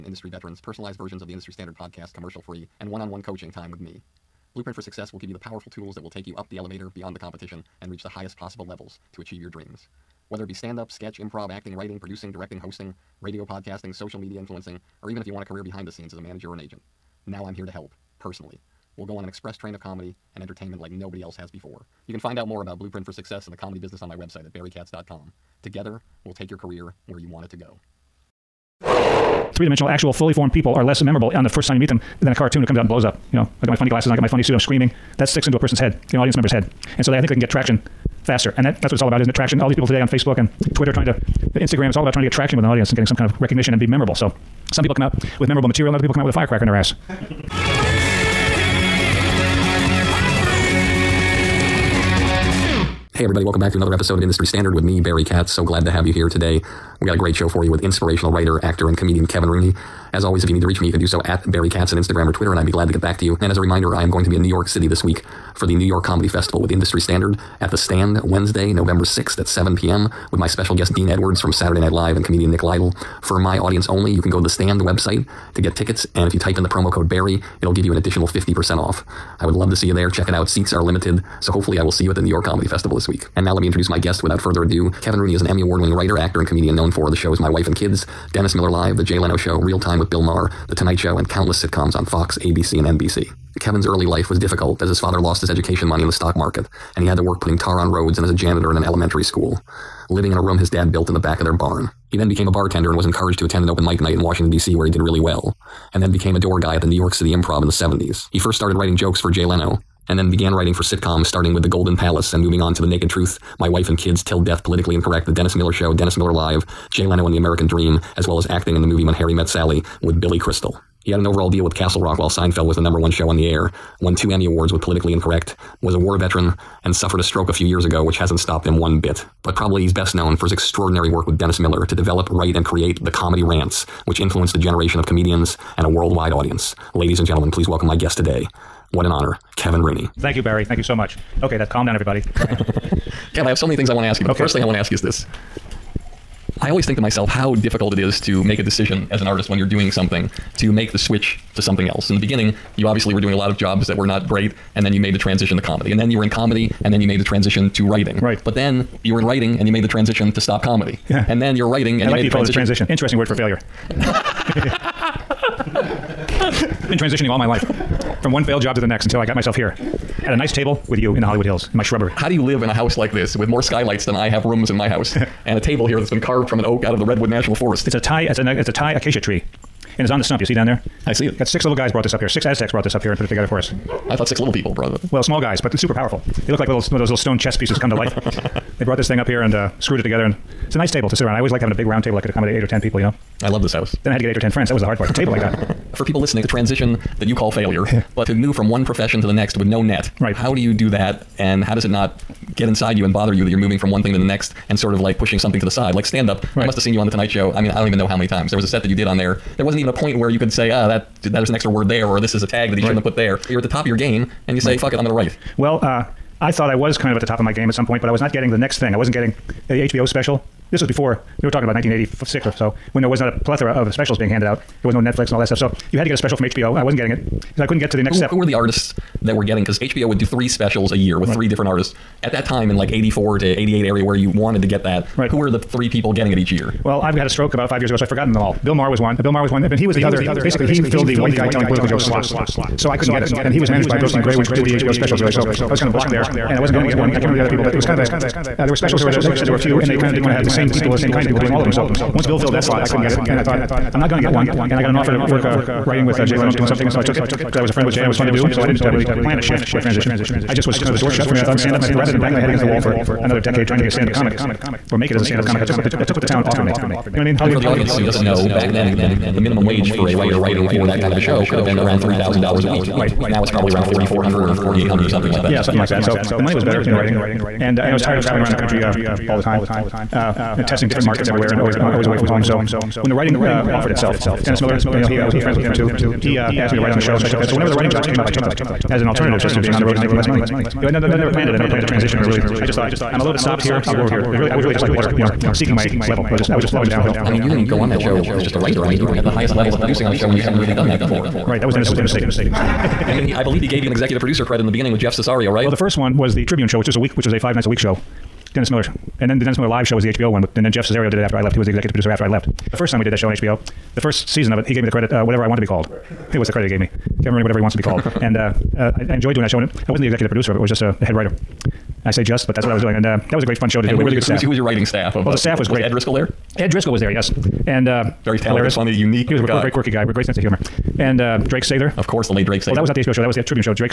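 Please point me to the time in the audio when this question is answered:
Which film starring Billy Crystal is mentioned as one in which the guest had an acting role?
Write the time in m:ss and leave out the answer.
1:59.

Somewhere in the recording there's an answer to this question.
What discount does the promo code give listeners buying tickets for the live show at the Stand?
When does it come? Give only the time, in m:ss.
1:18.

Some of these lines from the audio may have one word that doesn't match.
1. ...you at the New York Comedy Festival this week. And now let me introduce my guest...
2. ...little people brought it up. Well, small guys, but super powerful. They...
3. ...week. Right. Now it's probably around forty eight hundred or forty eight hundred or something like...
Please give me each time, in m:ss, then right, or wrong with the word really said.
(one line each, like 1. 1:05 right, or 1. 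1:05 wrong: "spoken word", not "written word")
1. 1:22 right
2. 3:04 right
3. 4:32 wrong: "four", not "eight".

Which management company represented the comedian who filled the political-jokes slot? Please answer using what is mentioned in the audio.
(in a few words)
Brillstein Grey.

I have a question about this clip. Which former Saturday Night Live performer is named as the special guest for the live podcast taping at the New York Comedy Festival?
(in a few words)
Dean Edwards.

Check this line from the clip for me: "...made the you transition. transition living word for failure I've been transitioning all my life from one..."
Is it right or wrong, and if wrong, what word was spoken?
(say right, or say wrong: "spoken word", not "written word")
wrong: "interesting", not "living".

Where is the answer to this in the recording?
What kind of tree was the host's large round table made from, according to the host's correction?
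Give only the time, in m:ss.
2:58.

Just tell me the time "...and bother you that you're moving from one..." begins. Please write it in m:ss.
3:23.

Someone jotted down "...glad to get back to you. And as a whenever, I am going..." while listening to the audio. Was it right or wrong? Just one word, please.
wrong.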